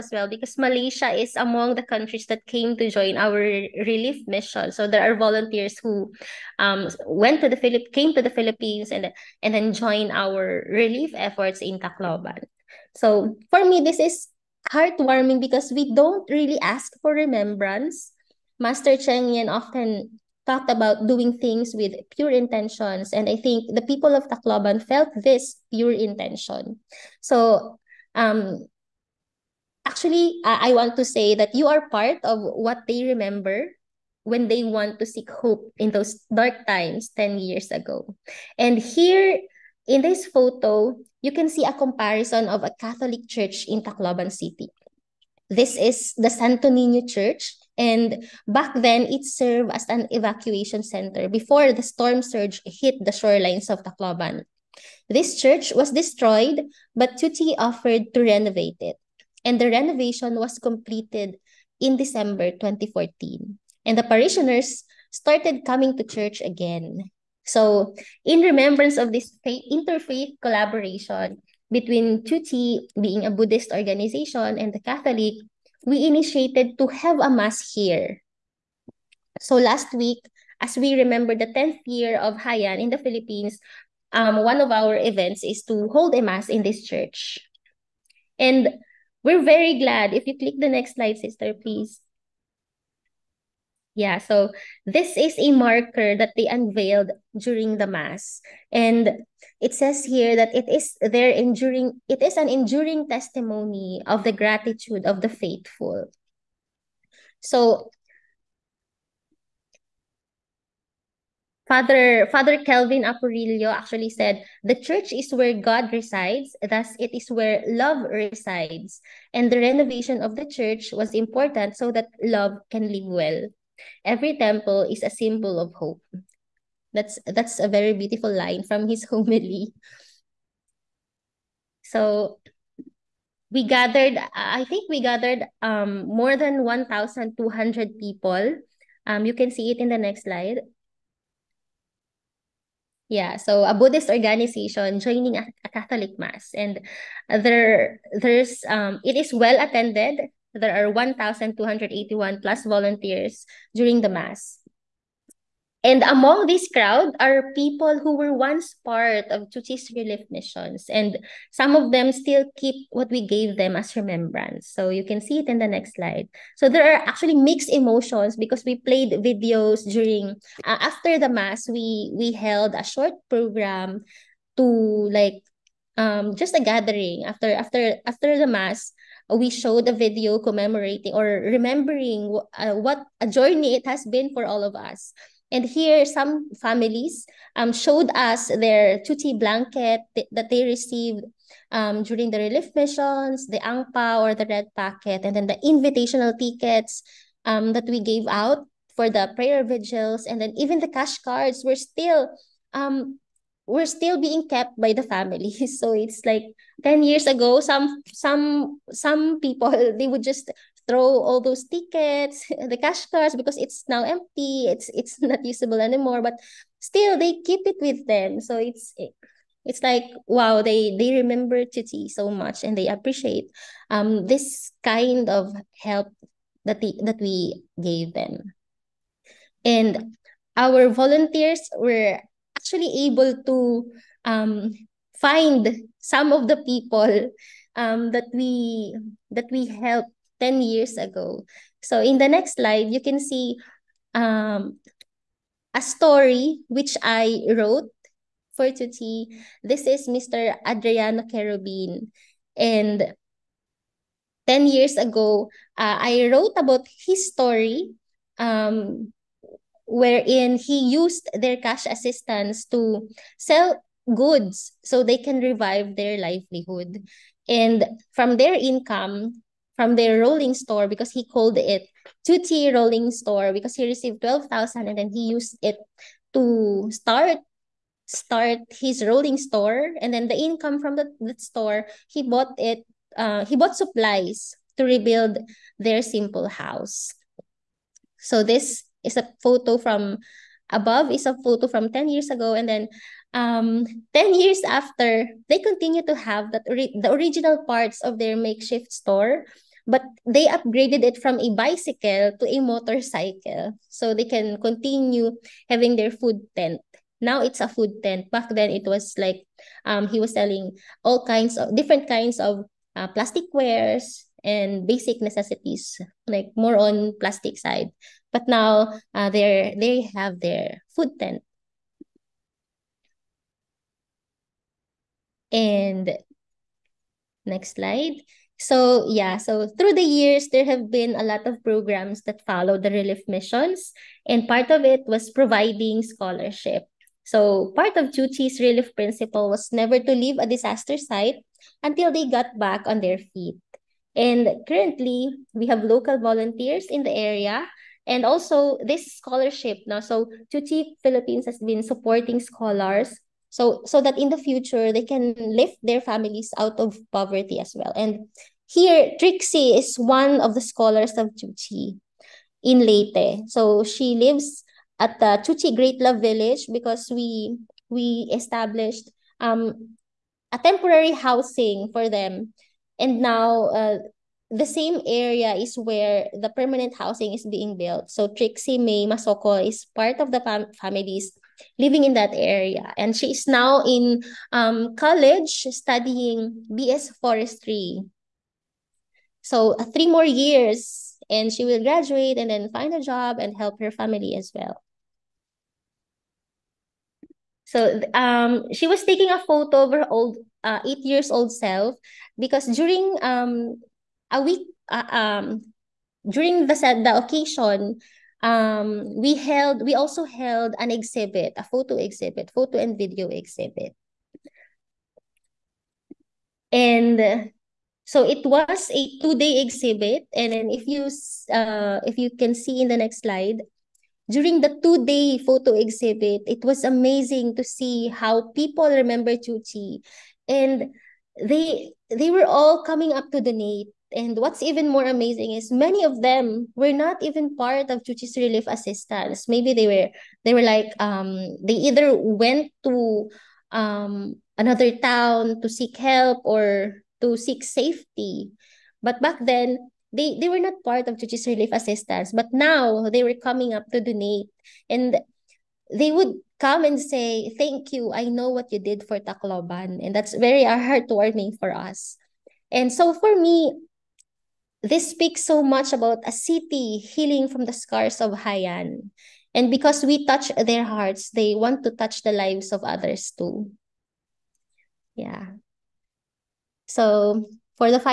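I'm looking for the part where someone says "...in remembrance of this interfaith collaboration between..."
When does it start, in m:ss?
1:08.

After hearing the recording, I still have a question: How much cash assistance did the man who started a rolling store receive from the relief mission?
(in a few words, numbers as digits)
12,000.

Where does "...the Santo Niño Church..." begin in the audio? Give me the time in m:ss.
0:46.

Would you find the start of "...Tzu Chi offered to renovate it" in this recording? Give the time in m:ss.
0:57.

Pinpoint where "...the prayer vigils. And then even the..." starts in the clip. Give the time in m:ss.
3:19.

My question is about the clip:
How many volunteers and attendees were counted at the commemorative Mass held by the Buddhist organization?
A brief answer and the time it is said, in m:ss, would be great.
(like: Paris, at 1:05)
1,281, at 2:30.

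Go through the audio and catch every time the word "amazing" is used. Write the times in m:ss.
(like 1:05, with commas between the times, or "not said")
7:06, 7:15.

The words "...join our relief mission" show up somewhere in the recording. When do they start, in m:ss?
0:02.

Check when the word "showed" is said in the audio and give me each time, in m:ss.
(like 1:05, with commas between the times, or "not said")
2:59, 3:07.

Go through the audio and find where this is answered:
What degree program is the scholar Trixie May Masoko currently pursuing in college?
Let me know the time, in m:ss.
6:26.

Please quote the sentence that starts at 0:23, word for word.
And I think the people of Tacloban felt this pure intention.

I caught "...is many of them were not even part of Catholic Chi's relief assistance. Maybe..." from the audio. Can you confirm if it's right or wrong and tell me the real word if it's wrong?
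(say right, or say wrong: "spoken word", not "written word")
wrong: "Tzu", not "Catholic".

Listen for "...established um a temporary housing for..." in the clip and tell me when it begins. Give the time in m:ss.
6:08.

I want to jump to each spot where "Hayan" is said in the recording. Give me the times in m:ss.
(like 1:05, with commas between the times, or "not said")
1:22.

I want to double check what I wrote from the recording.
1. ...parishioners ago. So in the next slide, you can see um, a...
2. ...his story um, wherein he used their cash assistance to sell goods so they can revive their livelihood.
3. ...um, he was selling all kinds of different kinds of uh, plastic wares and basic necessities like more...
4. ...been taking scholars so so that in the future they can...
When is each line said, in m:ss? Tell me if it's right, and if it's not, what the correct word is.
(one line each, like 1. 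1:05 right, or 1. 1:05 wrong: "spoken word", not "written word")
1. 4:00 wrong: "years", not "parishioners"
2. 4:17 right
3. 5:09 right
4. 5:51 wrong: "supporting", not "taking".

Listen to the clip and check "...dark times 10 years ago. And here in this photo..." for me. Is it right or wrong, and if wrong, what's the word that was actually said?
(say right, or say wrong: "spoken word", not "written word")
right.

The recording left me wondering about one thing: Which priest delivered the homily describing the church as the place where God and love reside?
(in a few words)
Father Kelvin Apurillo.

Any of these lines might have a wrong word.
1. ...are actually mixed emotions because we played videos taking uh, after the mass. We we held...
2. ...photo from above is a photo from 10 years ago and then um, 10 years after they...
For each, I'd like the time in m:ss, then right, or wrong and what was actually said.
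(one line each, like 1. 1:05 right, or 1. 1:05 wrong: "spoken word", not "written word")
1. 2:46 wrong: "during", not "taking"
2. 4:49 right.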